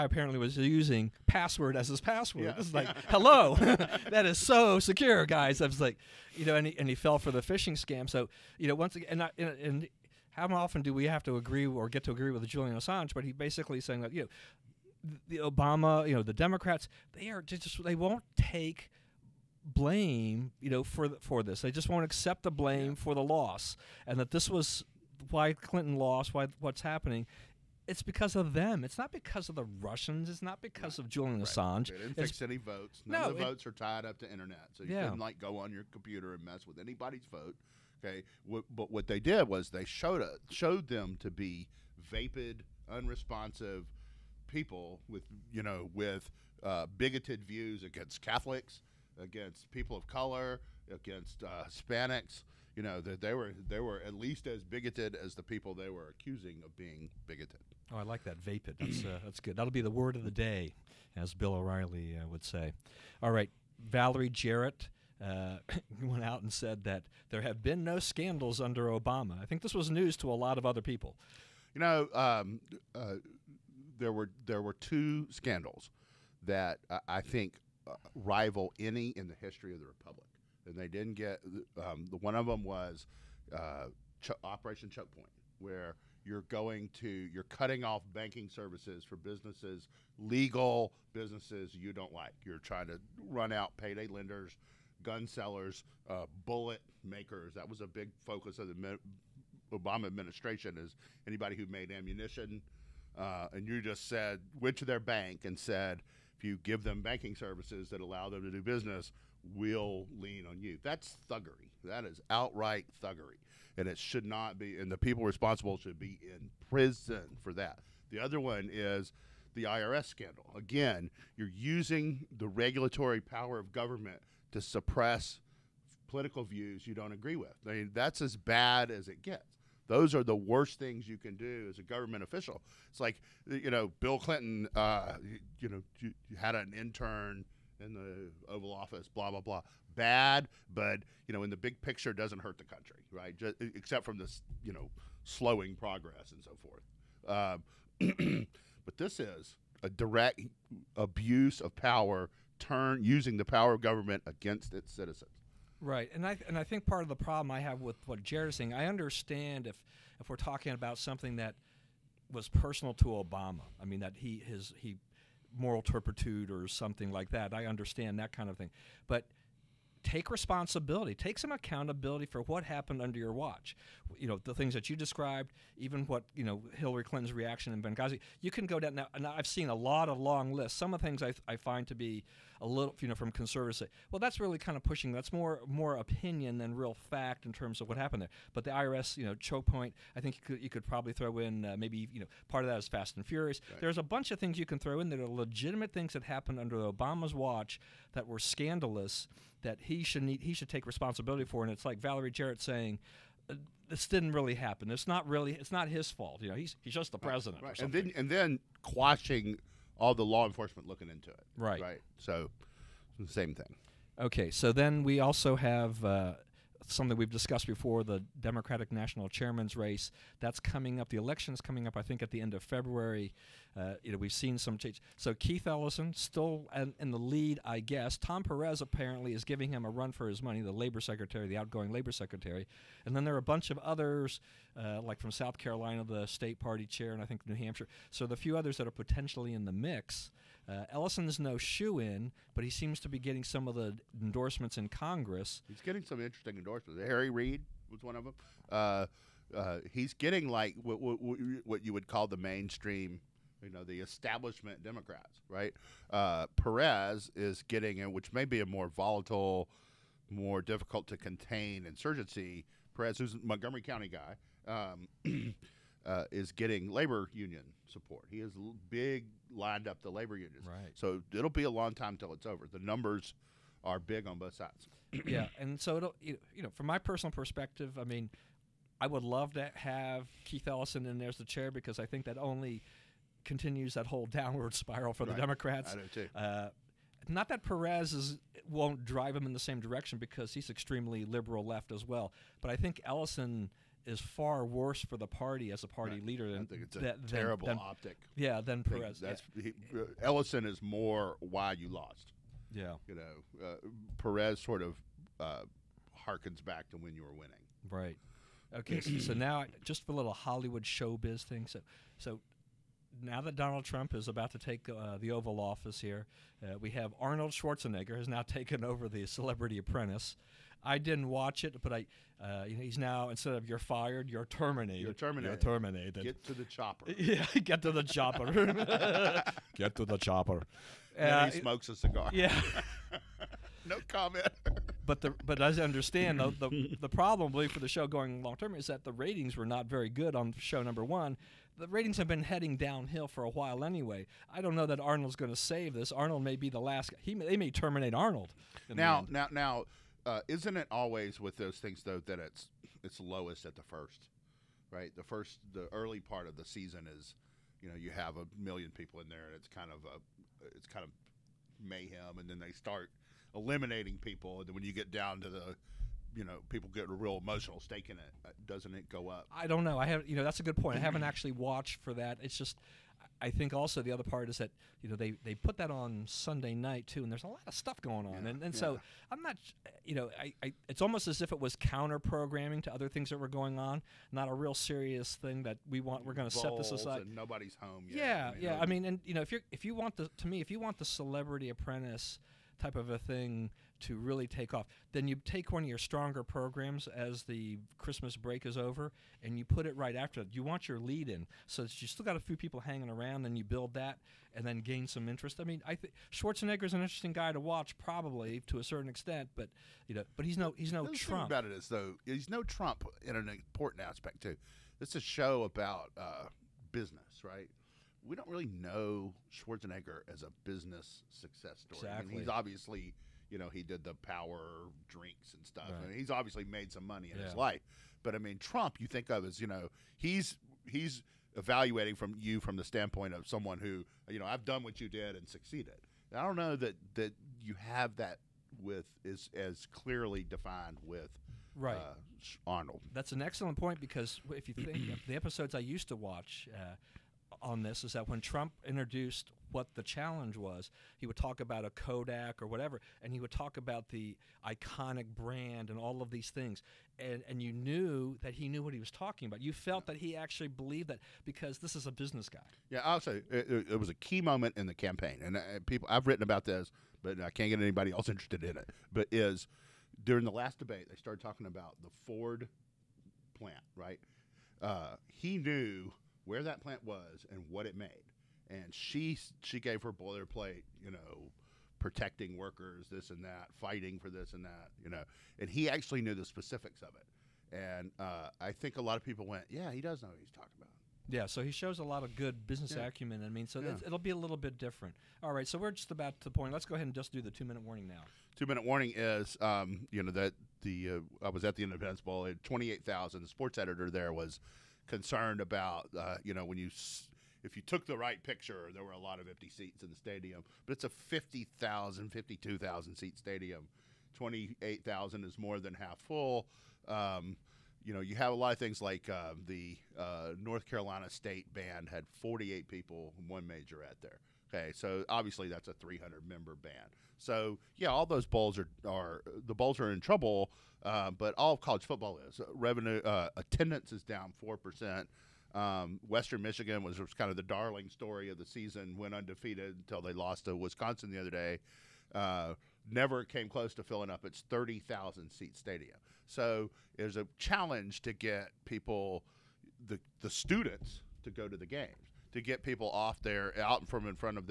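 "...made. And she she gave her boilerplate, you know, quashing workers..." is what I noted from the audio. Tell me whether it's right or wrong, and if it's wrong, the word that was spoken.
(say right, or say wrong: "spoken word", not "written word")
wrong: "protecting", not "quashing".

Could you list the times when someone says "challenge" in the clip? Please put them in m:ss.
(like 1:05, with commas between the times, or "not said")
7:30, 9:07.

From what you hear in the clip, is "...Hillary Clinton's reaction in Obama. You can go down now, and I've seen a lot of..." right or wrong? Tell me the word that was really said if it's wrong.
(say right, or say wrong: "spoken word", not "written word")
wrong: "Benghazi", not "Obama".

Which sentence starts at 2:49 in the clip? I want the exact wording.
But take responsibility, take some accountability for what happened under your watch.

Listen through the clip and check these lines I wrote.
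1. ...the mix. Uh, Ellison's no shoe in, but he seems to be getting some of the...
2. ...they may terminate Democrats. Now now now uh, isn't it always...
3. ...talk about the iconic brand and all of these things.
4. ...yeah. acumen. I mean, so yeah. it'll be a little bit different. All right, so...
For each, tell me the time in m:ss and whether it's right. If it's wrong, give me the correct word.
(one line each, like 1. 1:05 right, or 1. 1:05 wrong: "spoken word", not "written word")
1. 3:59 right
2. 5:47 wrong: "Arnold", not "Democrats"
3. 7:33 right
4. 8:12 right.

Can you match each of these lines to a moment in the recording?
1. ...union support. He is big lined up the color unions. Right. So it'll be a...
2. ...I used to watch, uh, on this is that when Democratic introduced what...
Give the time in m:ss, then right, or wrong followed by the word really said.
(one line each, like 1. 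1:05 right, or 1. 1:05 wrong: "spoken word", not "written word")
1. 4:27 wrong: "labor", not "color"
2. 7:25 wrong: "Trump", not "Democratic".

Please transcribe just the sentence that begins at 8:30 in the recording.
But it's a 50,000, 52,000 seat stadium.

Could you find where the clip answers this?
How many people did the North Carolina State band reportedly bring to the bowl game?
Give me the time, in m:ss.
8:42.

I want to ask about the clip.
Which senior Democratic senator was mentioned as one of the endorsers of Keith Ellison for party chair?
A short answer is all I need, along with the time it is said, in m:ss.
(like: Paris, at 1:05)
Harry Reid, at 4:07.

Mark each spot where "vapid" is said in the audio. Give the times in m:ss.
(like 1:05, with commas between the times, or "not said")
0:42, 0:58.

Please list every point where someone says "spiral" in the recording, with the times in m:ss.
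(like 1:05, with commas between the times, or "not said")
4:44.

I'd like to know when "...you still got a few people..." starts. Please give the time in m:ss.
6:42.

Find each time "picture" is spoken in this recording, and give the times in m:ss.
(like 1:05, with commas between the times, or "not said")
2:21, 8:28.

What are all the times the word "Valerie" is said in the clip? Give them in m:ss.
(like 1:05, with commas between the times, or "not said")
1:03, 3:21.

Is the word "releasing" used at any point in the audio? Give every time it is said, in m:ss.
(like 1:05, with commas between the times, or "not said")
not said.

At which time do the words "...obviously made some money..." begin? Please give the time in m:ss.
7:06.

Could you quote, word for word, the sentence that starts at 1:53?
And it should not be, and the people responsible should be in prison for that.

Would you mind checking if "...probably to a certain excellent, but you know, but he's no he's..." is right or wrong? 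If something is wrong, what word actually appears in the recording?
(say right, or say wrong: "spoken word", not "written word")
wrong: "extent", not "excellent".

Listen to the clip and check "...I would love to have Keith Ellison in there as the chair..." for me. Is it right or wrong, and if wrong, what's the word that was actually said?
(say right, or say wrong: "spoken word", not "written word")
right.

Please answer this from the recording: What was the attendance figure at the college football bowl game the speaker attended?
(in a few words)
28,000.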